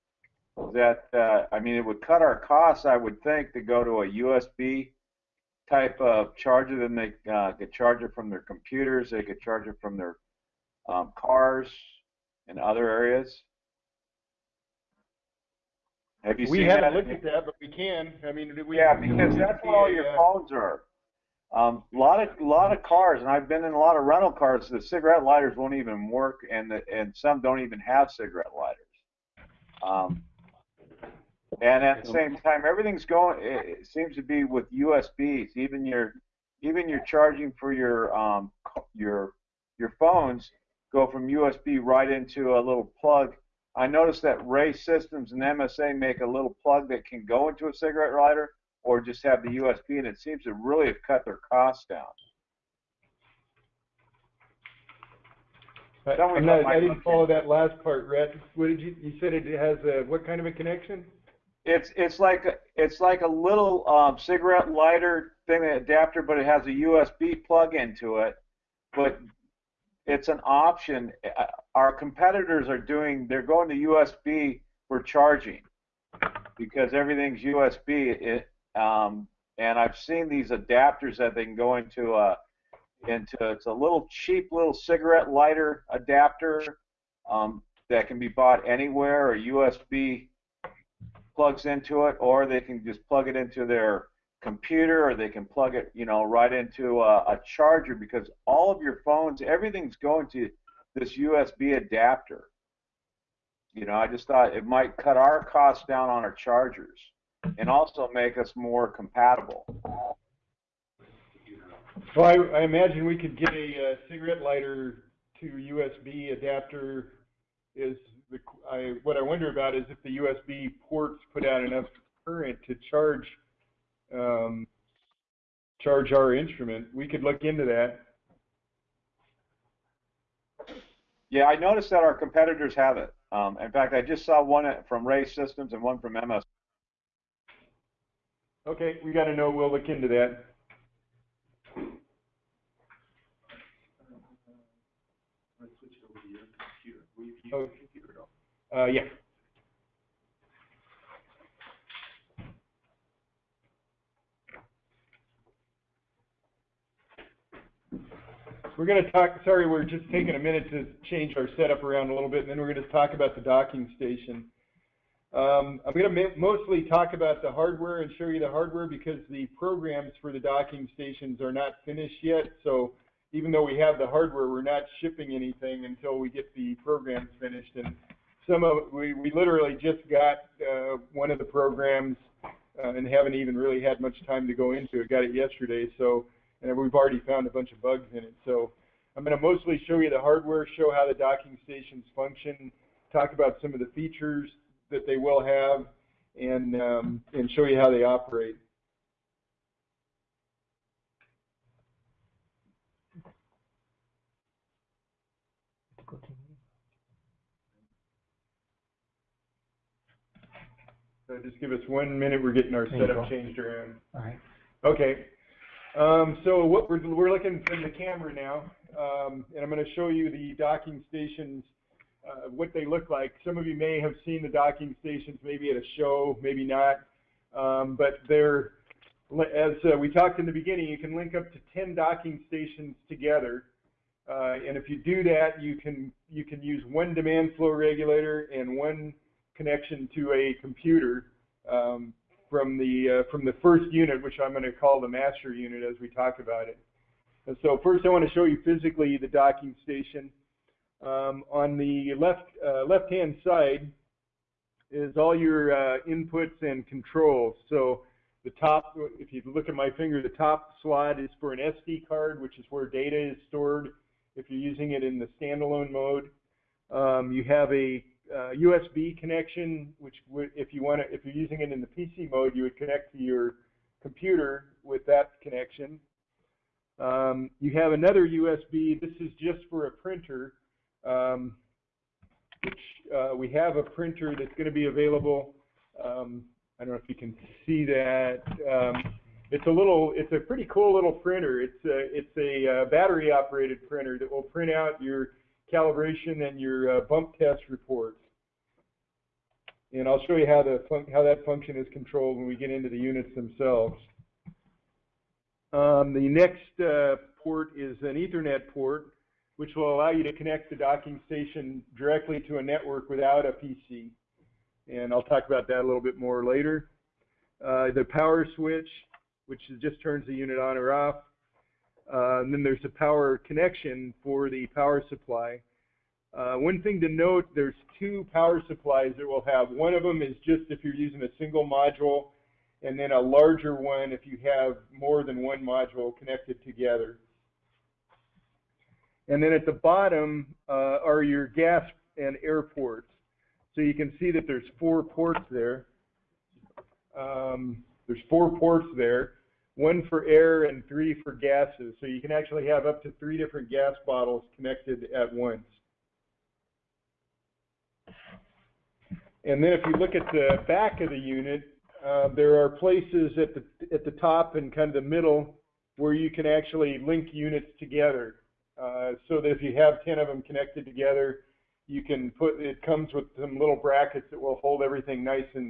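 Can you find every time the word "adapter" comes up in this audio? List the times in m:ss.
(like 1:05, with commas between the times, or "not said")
1:05, 1:20, 1:25, 1:41, 1:56.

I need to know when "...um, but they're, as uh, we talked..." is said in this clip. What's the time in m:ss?
3:47.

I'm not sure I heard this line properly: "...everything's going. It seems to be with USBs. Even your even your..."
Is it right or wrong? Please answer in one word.
right.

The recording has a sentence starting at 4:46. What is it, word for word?
Um, I don't know if you can see that.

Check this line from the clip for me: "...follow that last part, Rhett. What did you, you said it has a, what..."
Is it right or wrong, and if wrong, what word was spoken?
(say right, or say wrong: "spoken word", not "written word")
right.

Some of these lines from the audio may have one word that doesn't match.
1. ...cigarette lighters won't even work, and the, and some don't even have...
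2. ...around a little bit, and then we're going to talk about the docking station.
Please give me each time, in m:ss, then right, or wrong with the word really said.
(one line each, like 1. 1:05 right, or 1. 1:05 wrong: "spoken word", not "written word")
1. 0:24 right
2. 2:41 right.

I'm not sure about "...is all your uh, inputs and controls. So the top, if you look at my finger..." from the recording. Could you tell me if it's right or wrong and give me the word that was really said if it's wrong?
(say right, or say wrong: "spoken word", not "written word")
right.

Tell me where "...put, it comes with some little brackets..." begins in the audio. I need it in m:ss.
6:12.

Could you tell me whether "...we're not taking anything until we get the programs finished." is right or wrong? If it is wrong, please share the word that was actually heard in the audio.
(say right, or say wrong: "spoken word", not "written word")
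wrong: "shipping", not "taking".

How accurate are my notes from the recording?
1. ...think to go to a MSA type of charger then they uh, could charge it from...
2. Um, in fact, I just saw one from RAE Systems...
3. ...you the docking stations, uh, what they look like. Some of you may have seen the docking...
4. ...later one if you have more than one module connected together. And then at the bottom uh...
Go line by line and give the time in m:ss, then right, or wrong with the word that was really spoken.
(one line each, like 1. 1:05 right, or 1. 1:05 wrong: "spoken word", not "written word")
1. 0:03 wrong: "USB", not "MSA"
2. 2:13 right
3. 3:40 right
4. 5:33 wrong: "larger", not "later".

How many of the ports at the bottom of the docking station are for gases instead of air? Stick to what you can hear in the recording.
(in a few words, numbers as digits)
3.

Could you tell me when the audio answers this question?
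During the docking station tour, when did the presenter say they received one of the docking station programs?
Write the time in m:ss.
3:05.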